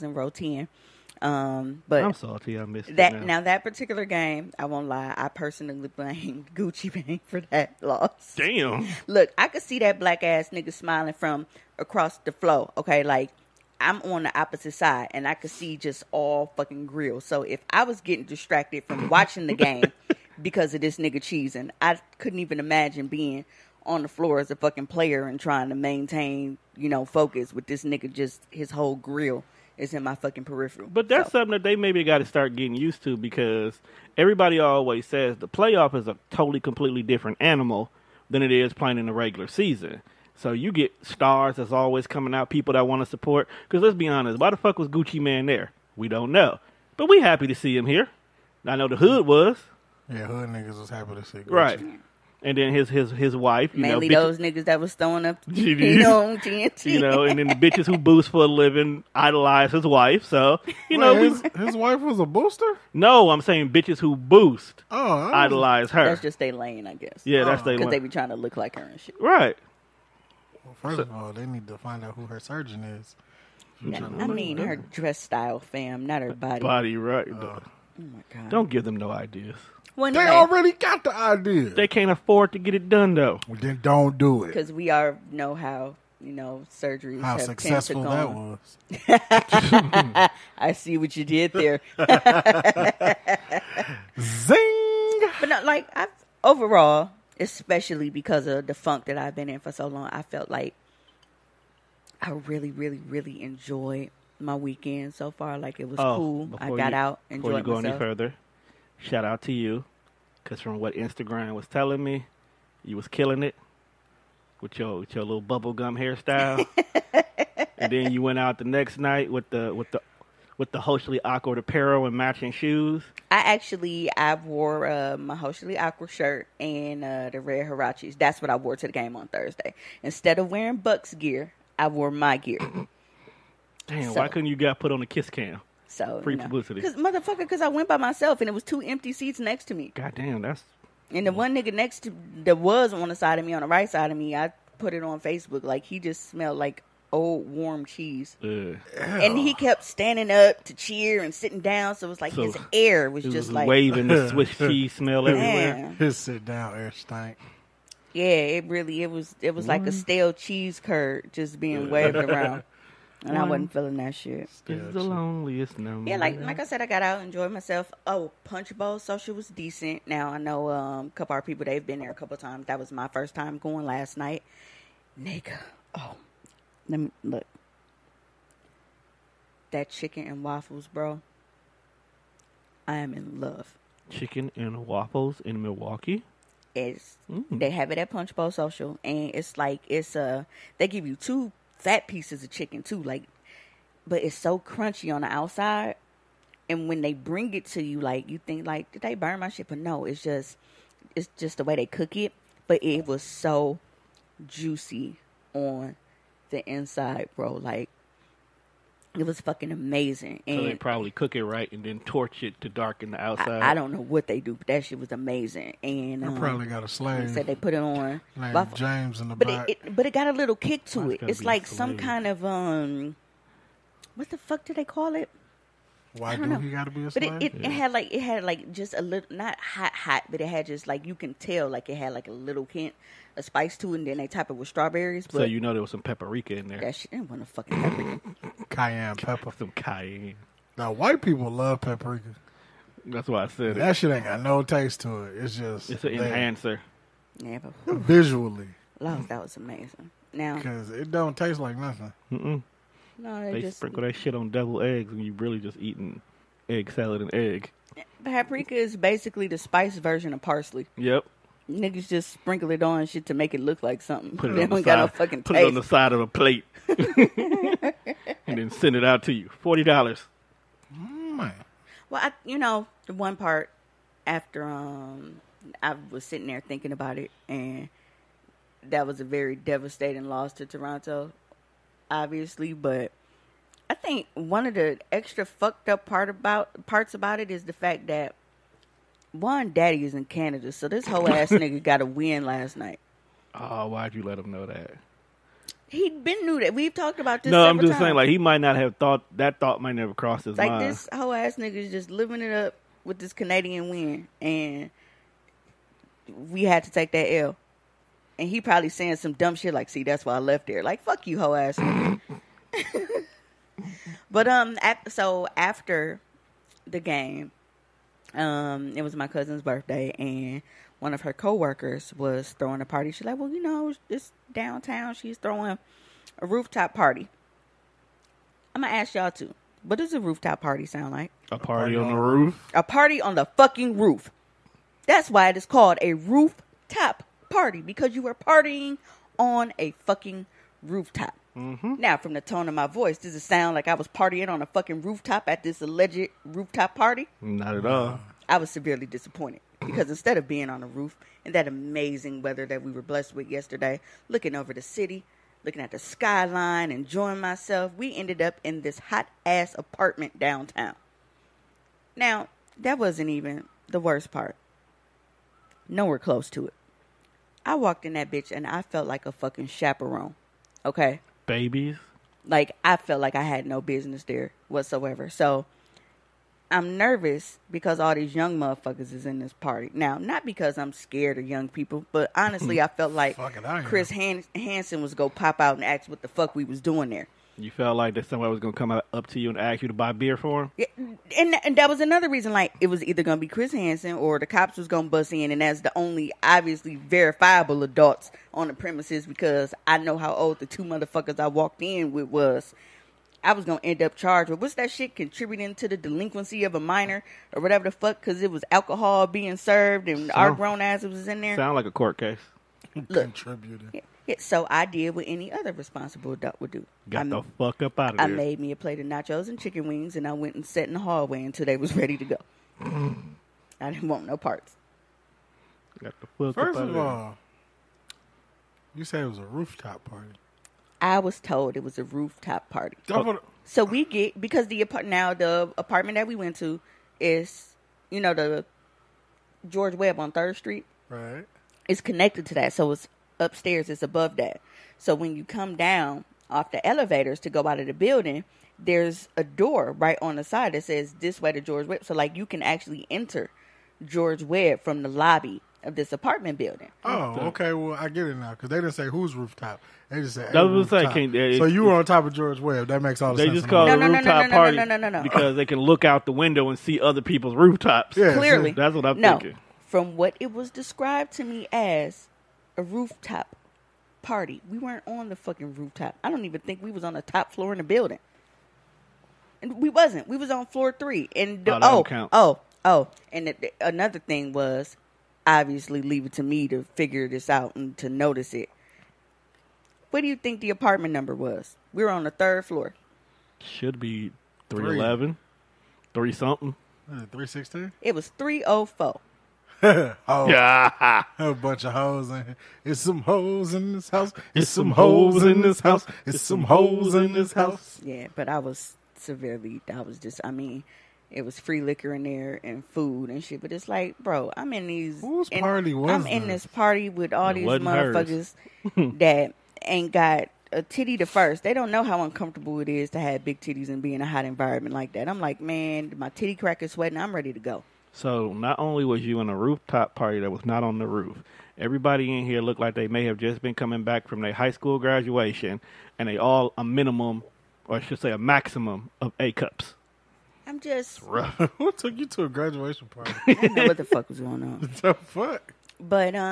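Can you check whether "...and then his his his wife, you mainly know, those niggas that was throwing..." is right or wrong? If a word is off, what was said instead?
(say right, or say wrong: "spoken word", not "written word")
right.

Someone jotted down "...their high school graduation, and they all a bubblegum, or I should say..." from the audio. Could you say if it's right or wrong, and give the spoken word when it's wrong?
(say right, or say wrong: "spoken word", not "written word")
wrong: "minimum", not "bubblegum".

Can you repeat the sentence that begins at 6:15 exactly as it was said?
So I'm nervous because all these young motherfuckers is in this party.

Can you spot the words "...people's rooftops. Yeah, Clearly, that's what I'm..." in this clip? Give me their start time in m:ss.
7:47.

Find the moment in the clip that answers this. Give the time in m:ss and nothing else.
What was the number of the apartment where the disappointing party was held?
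8:18.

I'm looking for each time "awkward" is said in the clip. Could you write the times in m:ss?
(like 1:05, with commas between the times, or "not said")
2:01, 2:05.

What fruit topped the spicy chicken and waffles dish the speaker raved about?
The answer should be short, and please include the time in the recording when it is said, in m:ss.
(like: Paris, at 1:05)
strawberries, at 3:54.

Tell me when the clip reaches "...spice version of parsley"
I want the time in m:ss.
4:19.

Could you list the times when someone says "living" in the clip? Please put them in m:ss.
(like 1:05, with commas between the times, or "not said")
0:58, 5:02.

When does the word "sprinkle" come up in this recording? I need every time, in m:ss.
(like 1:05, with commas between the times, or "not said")
4:13, 4:22.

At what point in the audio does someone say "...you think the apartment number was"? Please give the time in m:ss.
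8:10.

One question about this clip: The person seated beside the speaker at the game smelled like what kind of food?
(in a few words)
old warm cheese.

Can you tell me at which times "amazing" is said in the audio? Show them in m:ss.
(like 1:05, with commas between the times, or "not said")
3:29, 3:35, 4:09, 5:51.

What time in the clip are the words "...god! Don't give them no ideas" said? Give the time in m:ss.
1:18.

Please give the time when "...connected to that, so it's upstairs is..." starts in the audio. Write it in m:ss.
7:22.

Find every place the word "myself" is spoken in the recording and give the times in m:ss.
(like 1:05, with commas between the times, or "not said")
1:47, 2:17, 2:47, 5:57.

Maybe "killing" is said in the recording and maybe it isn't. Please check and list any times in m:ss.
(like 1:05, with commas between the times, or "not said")
1:53.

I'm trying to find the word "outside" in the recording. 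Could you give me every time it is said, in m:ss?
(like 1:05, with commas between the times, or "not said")
3:15, 3:33.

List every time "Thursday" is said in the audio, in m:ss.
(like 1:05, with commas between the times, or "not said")
2:09.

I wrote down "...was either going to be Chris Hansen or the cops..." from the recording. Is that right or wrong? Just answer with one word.
right.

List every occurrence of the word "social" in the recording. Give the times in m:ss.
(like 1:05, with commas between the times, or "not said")
2:48, 3:08.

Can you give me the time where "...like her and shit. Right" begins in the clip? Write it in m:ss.
1:08.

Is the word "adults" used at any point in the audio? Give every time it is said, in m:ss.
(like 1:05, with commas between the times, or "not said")
6:37, 6:56.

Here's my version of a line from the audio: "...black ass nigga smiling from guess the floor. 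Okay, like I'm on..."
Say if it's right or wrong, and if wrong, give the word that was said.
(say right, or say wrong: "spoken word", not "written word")
wrong: "across", not "guess".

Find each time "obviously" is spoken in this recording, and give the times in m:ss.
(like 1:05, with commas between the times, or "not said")
4:42, 6:36, 8:05.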